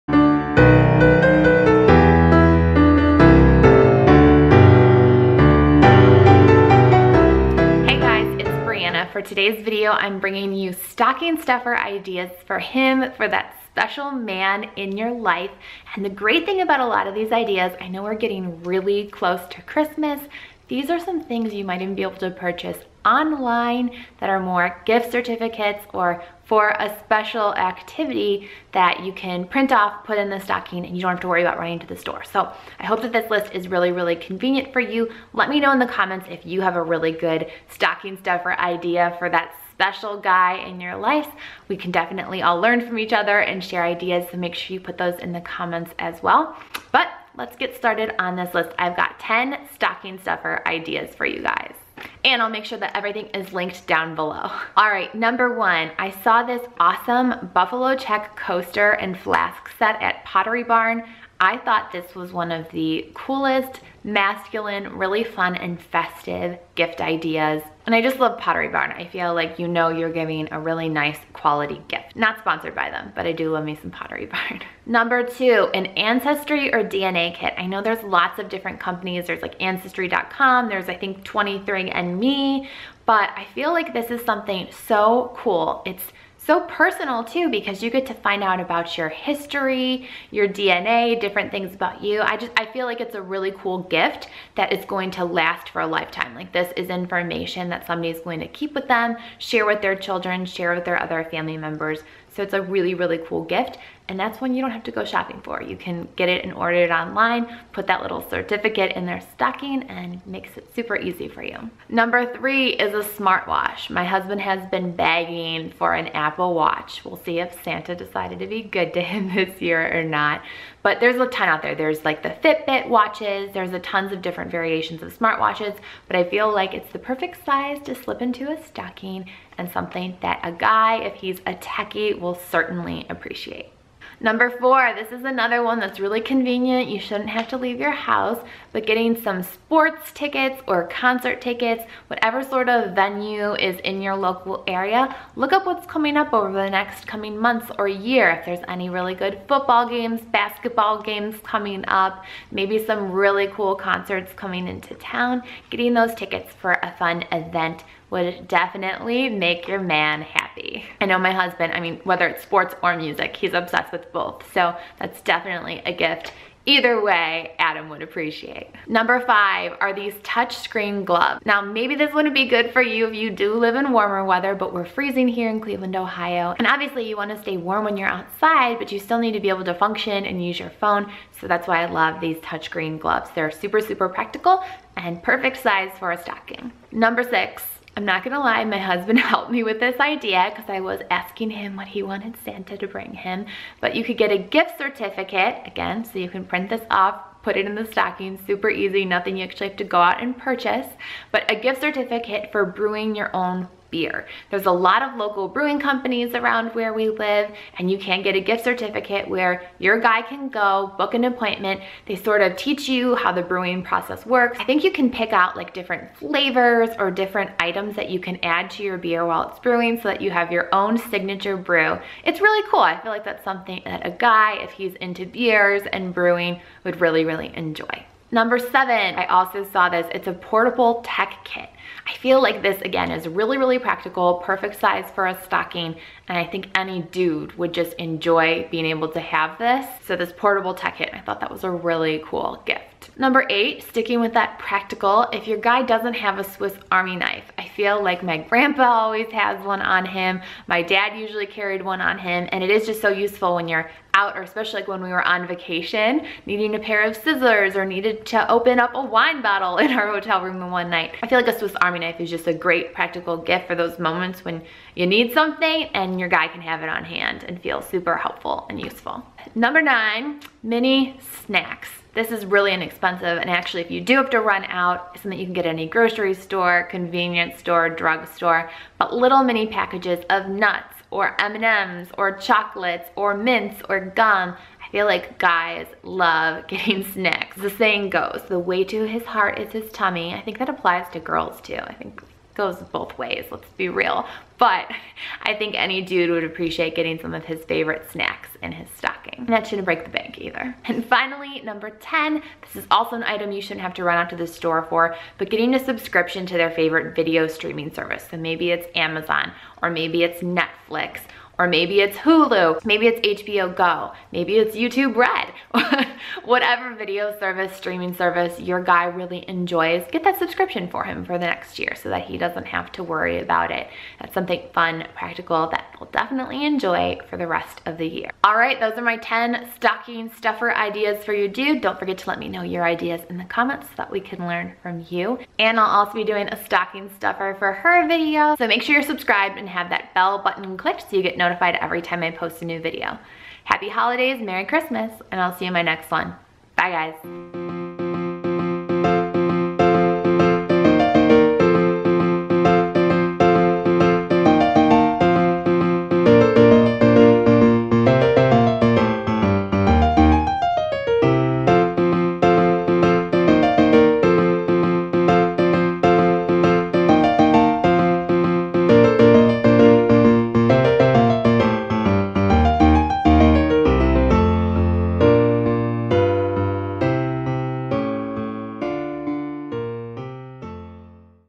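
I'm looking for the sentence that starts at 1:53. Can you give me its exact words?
My husband has been begging for an Apple Watch.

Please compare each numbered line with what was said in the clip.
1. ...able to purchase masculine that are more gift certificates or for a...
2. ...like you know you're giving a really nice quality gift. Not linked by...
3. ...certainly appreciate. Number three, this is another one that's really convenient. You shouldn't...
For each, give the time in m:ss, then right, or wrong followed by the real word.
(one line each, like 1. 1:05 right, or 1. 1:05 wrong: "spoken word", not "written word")
1. 0:22 wrong: "online", not "masculine"
2. 1:09 wrong: "sponsored", not "linked"
3. 2:12 wrong: "four", not "three".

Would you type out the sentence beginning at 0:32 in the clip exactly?
So I hope that this list is really, really convenient for you.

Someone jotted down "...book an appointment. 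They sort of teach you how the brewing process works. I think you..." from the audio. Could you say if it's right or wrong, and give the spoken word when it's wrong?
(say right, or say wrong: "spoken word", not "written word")
right.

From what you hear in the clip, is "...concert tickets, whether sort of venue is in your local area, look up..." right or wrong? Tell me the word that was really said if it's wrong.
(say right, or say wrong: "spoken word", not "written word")
wrong: "whatever", not "whether".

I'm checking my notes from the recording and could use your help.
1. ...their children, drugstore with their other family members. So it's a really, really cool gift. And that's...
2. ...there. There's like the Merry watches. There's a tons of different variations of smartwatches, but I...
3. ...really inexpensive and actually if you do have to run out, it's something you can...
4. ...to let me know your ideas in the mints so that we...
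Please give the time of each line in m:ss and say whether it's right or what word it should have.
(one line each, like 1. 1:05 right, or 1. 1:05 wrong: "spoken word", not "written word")
1. 1:39 wrong: "share", not "drugstore"
2. 2:01 wrong: "Fitbit", not "Merry"
3. 4:32 right
4. 5:32 wrong: "comments", not "mints".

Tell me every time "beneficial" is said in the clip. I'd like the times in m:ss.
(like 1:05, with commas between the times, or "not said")
not said.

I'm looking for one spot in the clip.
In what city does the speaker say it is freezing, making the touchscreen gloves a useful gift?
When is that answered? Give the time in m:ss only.
2:55.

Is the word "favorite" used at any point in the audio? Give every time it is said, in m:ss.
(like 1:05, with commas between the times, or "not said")
4:57, 5:06.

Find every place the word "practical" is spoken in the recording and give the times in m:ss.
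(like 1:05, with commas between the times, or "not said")
3:04, 3:53, 4:04, 4:22, 5:25.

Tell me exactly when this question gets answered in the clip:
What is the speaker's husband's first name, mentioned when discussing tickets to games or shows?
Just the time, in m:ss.
2:47.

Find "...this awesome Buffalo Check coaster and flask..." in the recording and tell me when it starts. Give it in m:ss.
0:56.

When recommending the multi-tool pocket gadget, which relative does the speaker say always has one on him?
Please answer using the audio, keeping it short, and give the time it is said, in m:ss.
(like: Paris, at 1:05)
grandpa, at 4:08.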